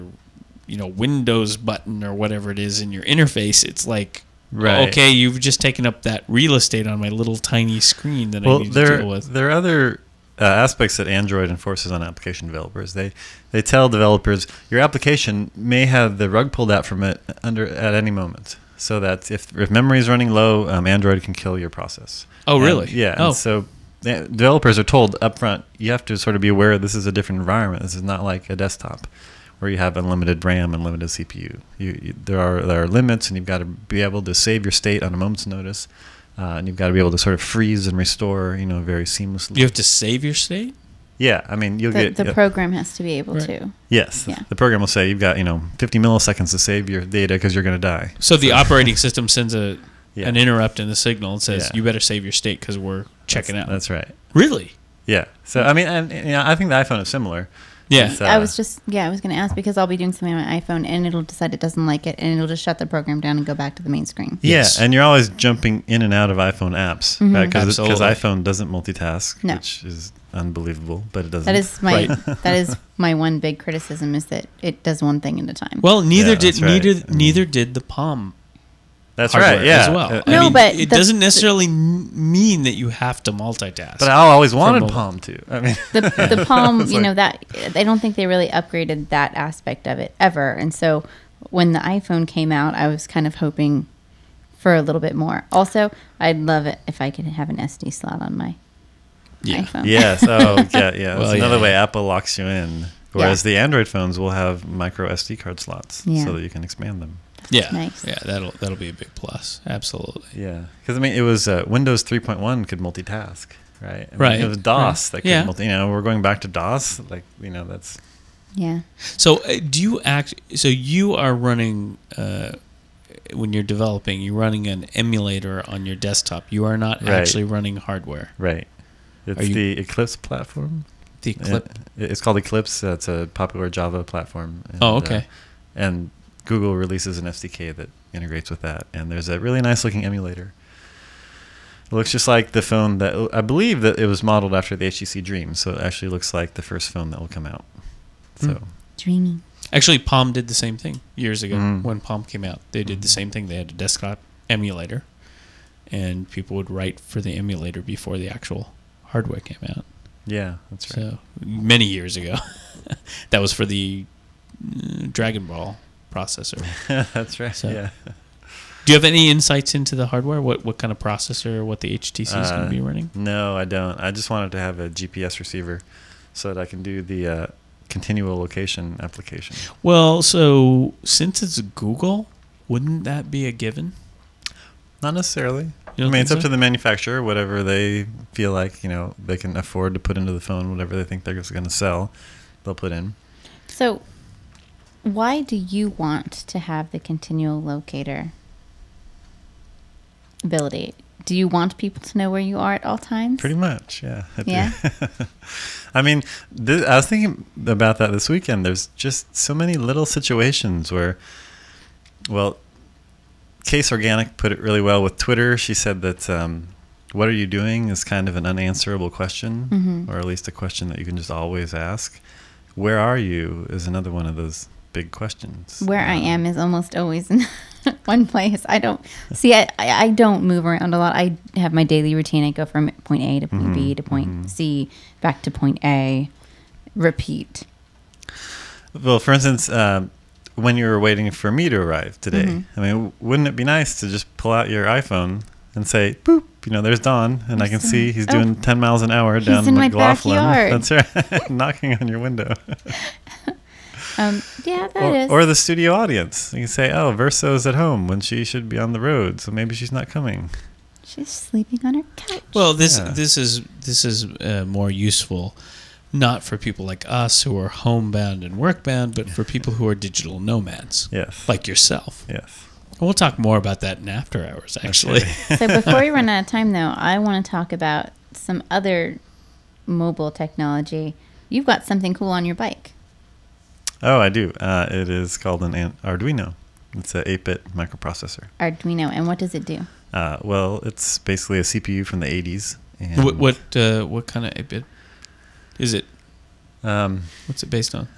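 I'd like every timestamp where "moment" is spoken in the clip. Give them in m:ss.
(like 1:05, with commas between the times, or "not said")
0:18, 0:35.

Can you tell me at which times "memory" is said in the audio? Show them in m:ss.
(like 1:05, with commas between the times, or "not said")
0:19.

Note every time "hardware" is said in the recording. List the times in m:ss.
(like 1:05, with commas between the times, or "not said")
2:07, 2:39, 2:50.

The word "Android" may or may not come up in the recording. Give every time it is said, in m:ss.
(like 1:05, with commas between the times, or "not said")
0:11, 0:20, 1:43.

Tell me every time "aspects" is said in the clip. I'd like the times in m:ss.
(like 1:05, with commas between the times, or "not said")
0:10, 1:29.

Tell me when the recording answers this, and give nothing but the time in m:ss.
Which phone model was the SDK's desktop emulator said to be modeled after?
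2:24.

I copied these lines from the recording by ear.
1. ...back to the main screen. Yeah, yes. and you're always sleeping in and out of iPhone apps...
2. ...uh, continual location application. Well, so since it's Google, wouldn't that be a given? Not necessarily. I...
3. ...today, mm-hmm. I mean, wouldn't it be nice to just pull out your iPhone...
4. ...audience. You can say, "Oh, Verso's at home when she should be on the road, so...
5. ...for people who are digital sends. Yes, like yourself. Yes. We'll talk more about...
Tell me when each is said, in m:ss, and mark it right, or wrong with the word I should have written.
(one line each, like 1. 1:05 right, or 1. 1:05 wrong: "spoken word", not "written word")
1. 1:03 wrong: "jumping", not "sleeping"
2. 2:57 right
3. 4:02 right
4. 4:15 right
5. 4:29 wrong: "nomads", not "sends".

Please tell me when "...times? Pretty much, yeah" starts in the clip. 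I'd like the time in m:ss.
3:22.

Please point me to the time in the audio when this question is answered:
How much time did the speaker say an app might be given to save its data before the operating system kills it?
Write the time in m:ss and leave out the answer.
0:45.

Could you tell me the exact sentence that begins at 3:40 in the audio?
or at least a question that you can just always ask.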